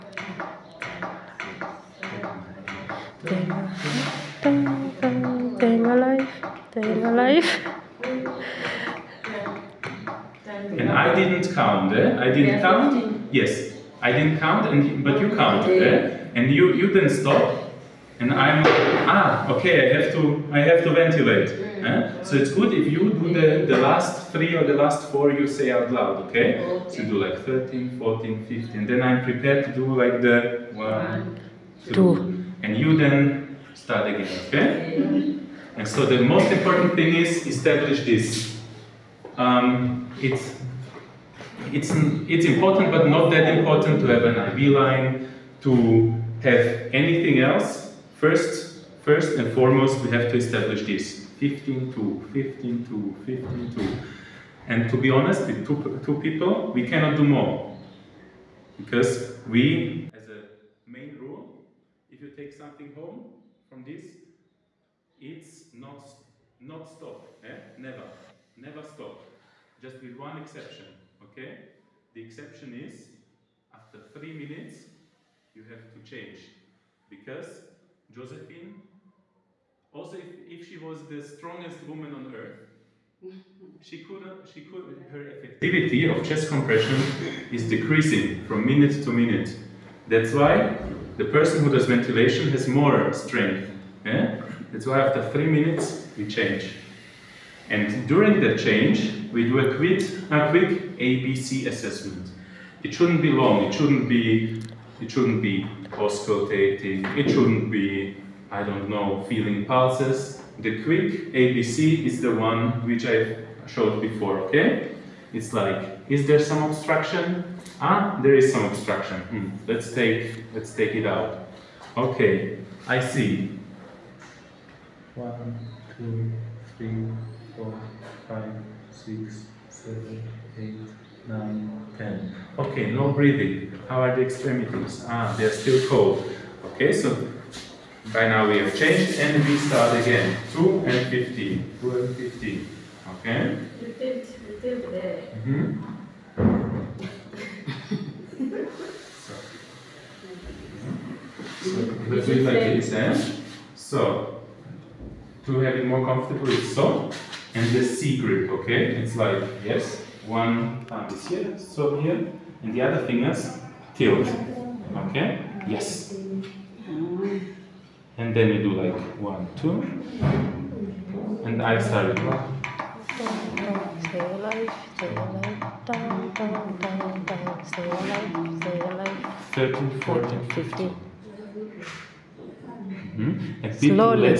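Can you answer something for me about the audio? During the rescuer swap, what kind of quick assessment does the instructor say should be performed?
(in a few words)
ABC assessment.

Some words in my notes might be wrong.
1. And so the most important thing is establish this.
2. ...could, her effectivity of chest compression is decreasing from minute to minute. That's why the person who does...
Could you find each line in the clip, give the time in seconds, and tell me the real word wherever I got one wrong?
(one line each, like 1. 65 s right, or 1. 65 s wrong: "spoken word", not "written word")
1. 35 s right
2. 84 s right.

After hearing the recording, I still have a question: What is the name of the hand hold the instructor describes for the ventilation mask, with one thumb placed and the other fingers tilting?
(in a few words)
C grip.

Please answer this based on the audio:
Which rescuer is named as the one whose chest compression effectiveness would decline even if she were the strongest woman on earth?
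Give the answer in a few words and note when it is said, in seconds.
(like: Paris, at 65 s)
Josephine, at 78 s.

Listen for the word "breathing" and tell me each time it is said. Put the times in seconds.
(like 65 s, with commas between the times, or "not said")
133 s.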